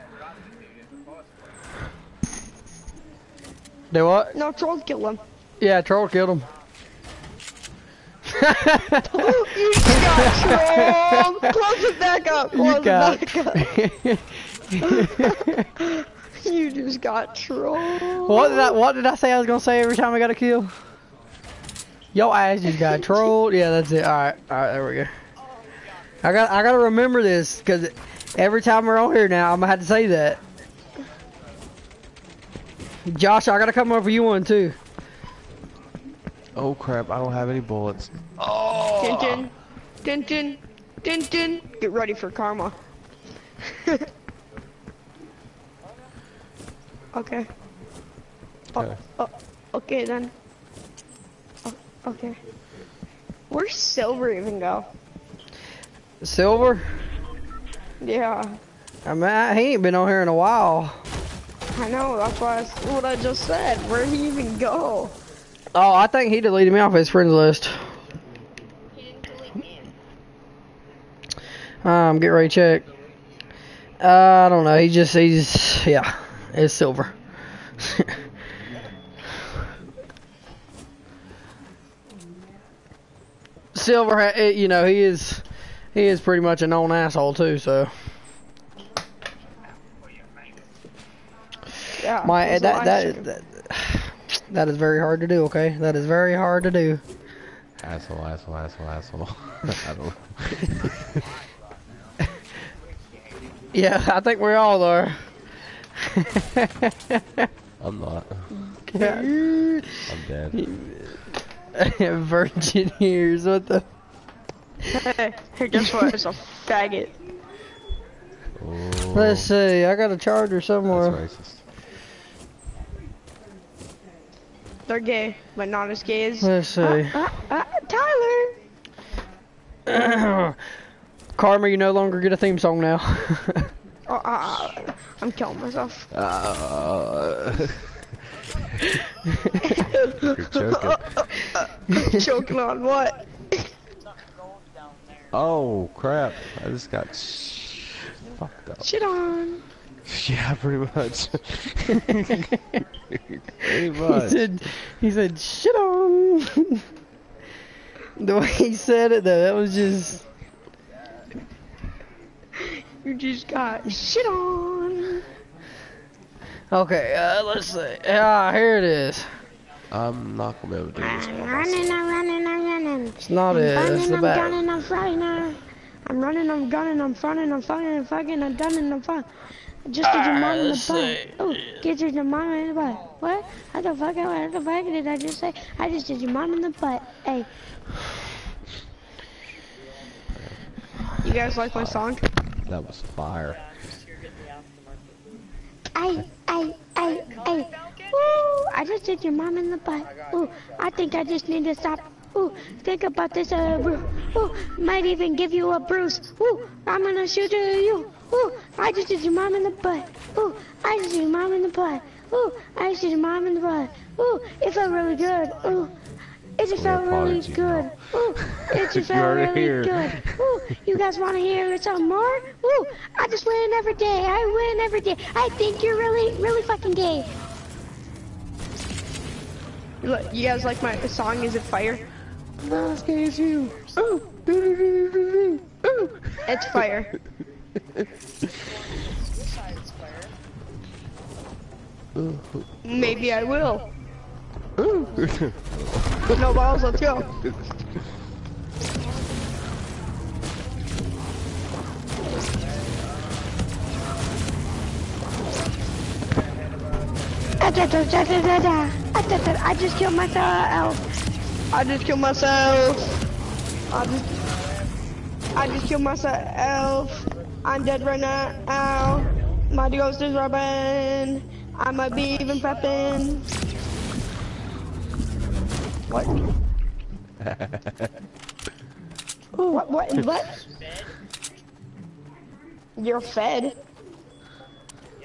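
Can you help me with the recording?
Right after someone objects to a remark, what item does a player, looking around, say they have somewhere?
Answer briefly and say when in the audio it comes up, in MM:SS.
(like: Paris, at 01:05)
a charger, at 01:59.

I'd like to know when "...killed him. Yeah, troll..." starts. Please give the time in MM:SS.
00:04.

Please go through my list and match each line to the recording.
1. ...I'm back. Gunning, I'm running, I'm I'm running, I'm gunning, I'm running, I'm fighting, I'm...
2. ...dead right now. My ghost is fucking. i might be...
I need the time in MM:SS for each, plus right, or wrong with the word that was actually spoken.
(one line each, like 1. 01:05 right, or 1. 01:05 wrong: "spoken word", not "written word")
1. 02:54 right
2. 04:27 wrong: "rubbing", not "fucking".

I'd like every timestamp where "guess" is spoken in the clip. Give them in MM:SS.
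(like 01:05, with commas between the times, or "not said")
01:55.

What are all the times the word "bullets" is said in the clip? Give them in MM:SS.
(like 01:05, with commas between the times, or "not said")
00:37.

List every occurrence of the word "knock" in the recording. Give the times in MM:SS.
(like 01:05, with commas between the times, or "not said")
not said.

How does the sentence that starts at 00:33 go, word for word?
Josh, I gotta come over you one too.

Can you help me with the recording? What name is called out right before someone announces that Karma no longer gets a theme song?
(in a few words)
Tyler.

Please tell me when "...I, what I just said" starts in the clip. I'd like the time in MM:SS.
01:02.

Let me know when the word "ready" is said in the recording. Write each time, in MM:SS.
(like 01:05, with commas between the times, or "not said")
00:41, 01:12.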